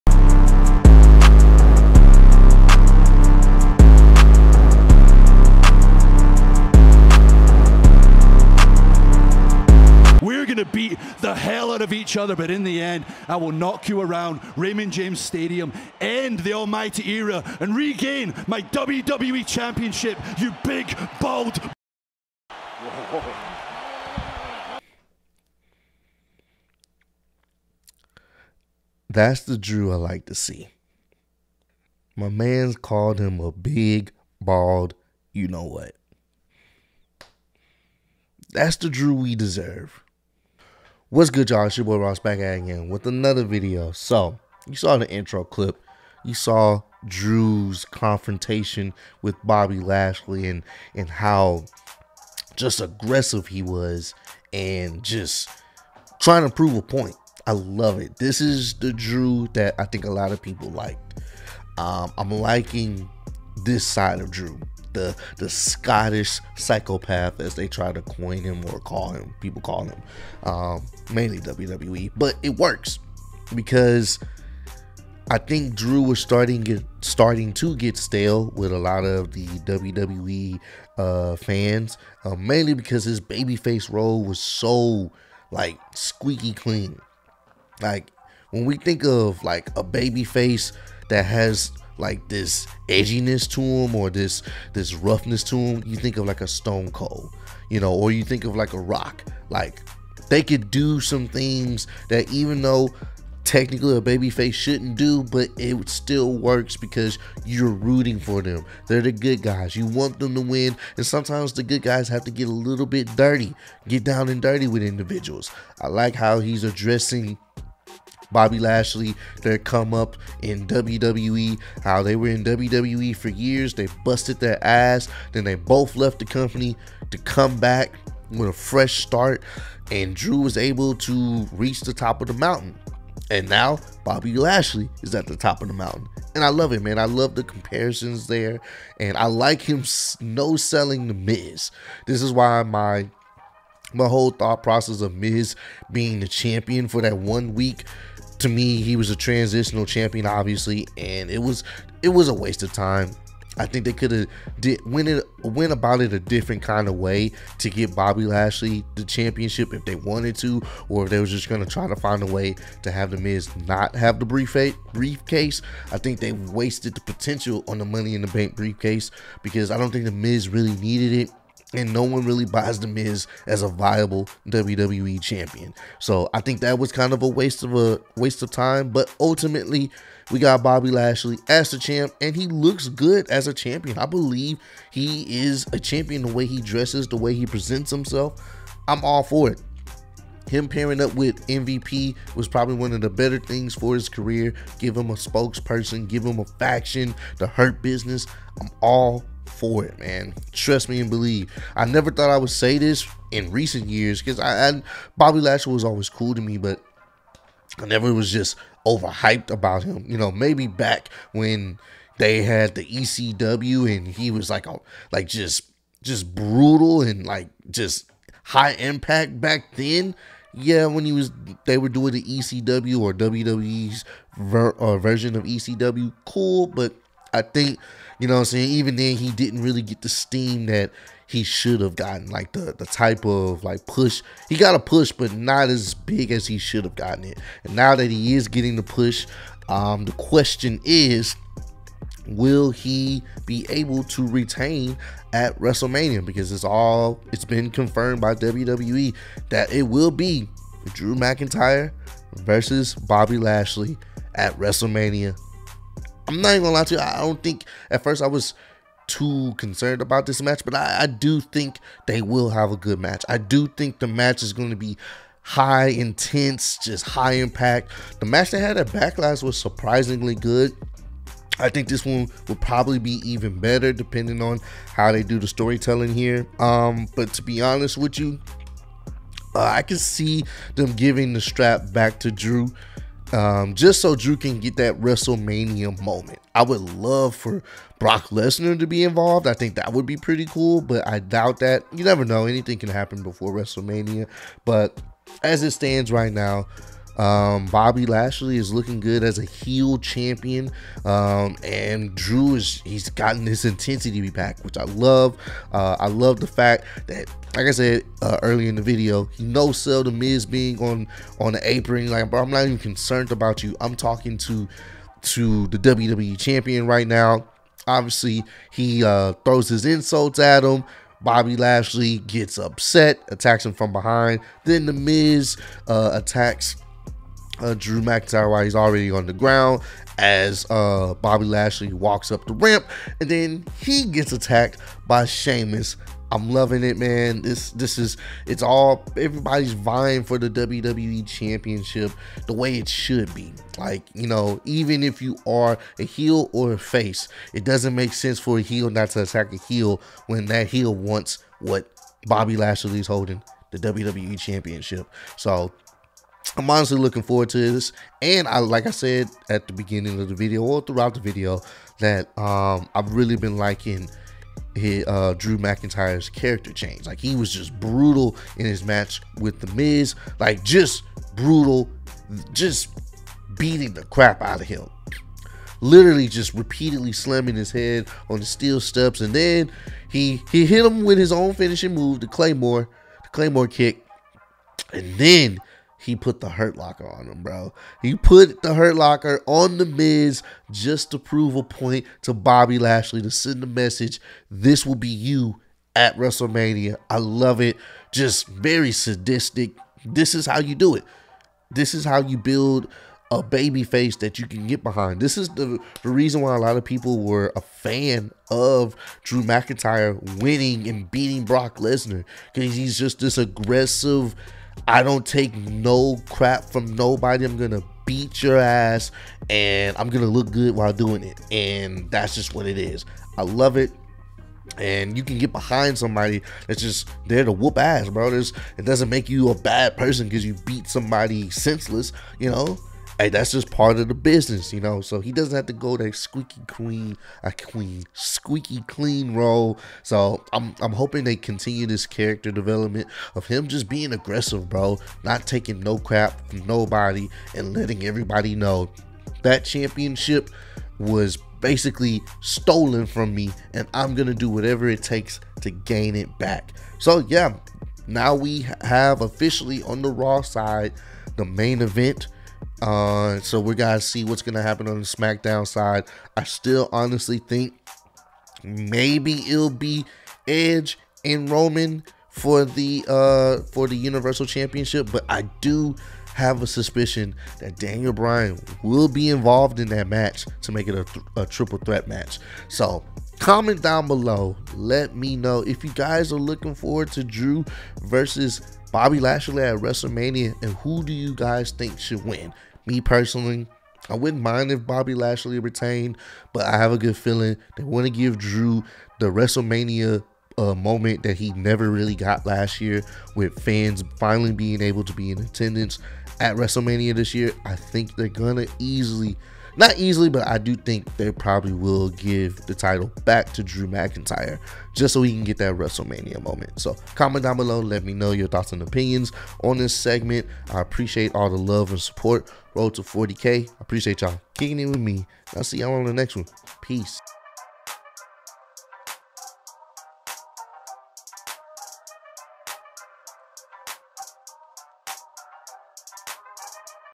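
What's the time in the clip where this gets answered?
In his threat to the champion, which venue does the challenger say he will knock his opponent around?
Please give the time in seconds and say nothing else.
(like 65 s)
14 s.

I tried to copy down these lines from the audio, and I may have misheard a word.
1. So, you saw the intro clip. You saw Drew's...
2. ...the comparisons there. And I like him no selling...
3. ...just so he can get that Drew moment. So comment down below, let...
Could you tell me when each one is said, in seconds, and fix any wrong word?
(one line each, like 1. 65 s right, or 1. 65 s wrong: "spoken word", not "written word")
1. 43 s right
2. 137 s right
3. 514 s wrong: "WrestleMania", not "Drew".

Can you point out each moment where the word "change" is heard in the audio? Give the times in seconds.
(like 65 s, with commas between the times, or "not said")
366 s.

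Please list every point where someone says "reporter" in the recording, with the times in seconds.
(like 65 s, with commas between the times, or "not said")
not said.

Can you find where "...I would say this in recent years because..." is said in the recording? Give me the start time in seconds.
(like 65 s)
202 s.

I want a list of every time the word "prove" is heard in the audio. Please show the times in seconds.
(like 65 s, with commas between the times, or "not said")
56 s, 391 s.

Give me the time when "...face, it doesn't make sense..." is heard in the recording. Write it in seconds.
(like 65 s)
346 s.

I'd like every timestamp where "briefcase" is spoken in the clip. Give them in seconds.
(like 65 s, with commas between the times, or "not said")
164 s, 168 s.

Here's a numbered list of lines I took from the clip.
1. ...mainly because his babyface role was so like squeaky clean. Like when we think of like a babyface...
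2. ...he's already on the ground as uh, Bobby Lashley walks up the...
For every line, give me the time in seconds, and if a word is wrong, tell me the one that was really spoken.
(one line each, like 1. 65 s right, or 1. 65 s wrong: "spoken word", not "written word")
1. 82 s right
2. 328 s right.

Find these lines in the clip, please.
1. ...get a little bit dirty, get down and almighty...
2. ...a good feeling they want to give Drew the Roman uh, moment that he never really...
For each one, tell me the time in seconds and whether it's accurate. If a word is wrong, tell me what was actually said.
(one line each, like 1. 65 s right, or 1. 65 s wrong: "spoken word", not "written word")
1. 112 s wrong: "dirty", not "almighty"
2. 496 s wrong: "WrestleMania", not "Roman".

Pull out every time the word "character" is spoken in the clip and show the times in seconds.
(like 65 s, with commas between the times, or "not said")
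366 s, 442 s.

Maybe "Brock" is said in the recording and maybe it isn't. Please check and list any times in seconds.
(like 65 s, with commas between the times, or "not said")
287 s, 411 s.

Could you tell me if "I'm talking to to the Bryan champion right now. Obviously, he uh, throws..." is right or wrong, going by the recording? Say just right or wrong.
wrong.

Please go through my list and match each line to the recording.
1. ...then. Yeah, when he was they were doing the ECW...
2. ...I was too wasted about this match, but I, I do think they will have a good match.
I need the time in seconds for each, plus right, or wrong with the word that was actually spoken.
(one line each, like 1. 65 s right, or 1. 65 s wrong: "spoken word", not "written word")
1. 219 s right
2. 258 s wrong: "concerned", not "wasted".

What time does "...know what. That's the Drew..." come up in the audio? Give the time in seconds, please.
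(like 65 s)
35 s.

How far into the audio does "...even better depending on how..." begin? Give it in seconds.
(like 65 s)
273 s.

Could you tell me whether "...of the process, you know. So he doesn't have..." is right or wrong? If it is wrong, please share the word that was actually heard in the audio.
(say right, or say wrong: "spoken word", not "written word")
wrong: "business", not "process".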